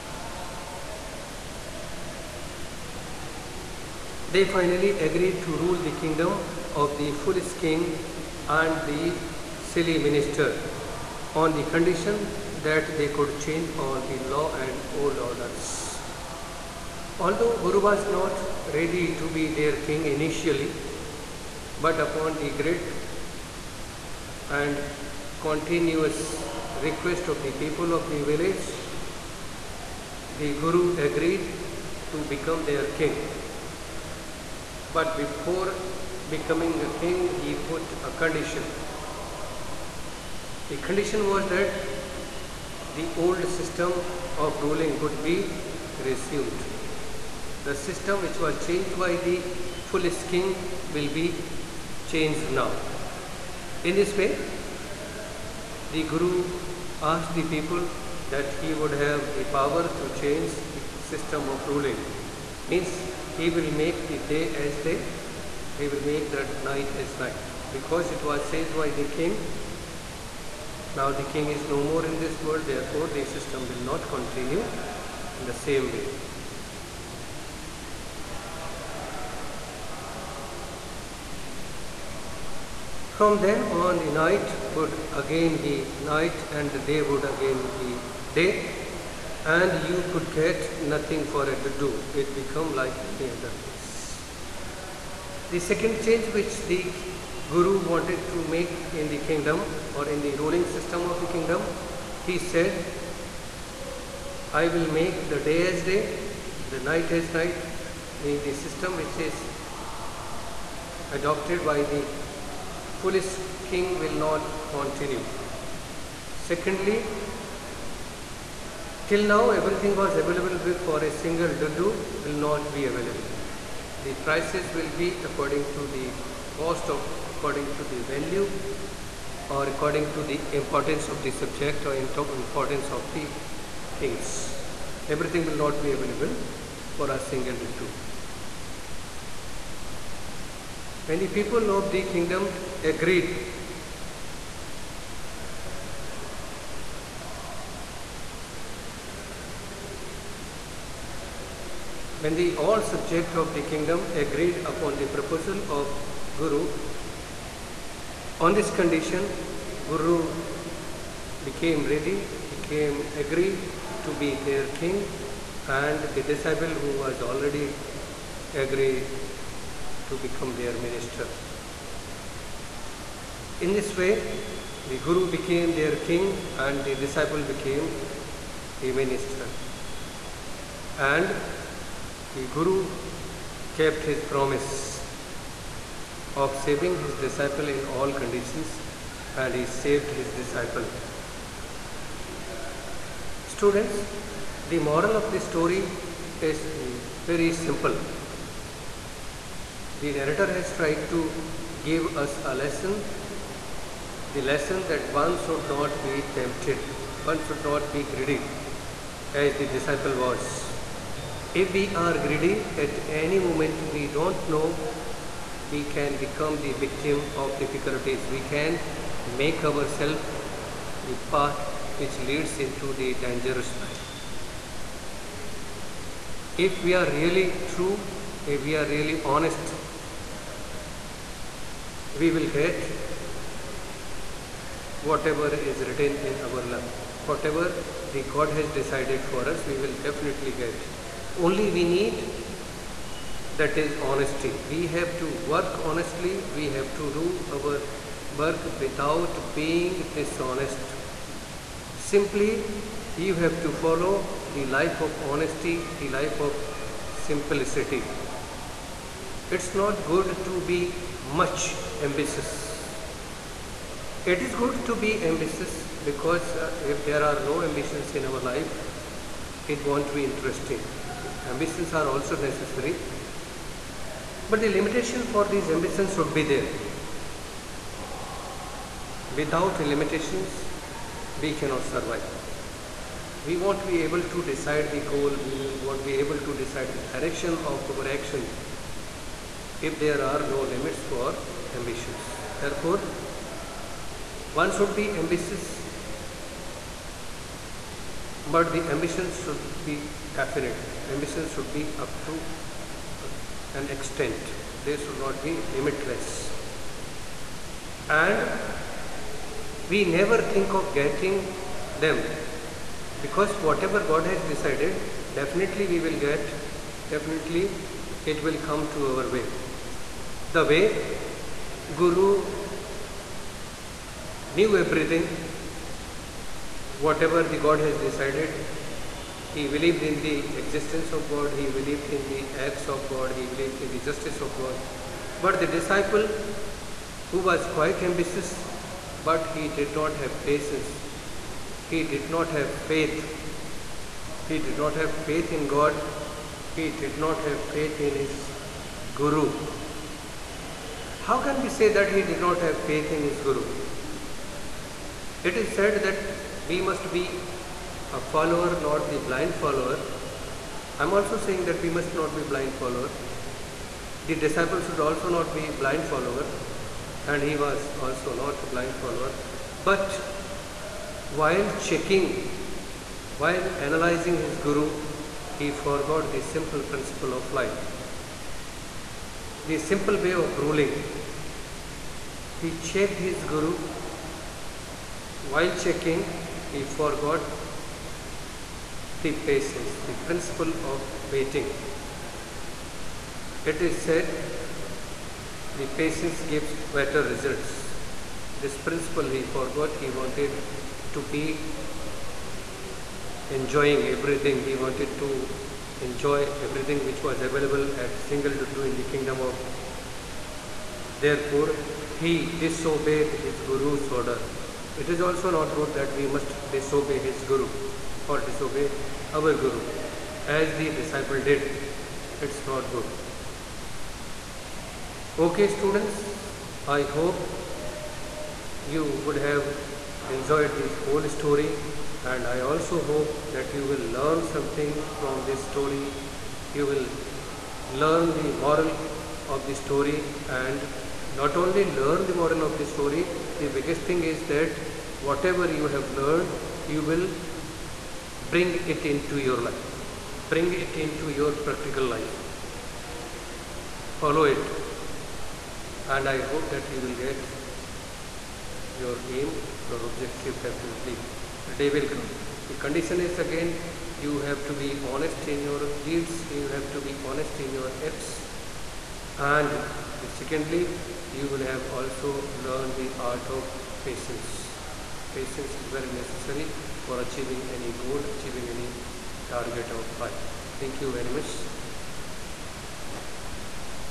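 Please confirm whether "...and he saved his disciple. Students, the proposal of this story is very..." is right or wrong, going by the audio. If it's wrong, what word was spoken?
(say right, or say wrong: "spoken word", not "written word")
wrong: "moral", not "proposal".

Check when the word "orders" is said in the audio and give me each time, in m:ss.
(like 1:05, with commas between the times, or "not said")
0:15, 6:54.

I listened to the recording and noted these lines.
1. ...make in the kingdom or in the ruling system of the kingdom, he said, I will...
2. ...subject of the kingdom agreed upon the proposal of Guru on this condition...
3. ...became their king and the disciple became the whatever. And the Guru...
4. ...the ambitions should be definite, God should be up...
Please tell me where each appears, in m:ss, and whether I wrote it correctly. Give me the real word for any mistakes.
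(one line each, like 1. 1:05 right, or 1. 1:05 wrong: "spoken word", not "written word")
1. 1:38 right
2. 2:32 right
3. 2:55 wrong: "minister", not "whatever"
4. 4:58 wrong: "Ambitions", not "God".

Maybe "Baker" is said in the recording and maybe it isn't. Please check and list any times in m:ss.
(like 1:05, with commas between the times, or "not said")
not said.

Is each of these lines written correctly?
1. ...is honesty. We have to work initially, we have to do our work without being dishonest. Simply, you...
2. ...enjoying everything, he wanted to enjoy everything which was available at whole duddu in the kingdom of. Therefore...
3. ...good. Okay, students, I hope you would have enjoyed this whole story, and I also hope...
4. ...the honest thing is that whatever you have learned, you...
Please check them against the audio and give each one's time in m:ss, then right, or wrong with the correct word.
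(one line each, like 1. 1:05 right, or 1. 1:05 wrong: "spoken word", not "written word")
1. 4:03 wrong: "honestly", not "initially"
2. 6:43 wrong: "single", not "whole"
3. 7:02 right
4. 7:23 wrong: "biggest", not "honest".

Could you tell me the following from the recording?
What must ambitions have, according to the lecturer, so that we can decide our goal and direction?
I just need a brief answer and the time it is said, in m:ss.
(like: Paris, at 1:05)
limitations, at 4:34.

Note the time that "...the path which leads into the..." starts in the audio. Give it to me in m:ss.
3:41.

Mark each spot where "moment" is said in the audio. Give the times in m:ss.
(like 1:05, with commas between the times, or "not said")
3:33.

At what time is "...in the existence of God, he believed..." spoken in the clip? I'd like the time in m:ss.
5:30.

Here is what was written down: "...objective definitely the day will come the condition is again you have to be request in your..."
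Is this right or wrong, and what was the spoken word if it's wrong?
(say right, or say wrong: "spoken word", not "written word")
wrong: "honest", not "request".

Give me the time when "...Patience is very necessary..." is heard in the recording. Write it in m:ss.
7:55.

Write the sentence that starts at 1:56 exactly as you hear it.
Secondly, till now everything was available for a single duddu will not be available.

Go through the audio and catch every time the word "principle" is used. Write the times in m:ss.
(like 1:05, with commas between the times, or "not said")
6:16, 6:30, 6:38.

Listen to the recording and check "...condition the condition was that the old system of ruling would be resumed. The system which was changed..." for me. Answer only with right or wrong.
right.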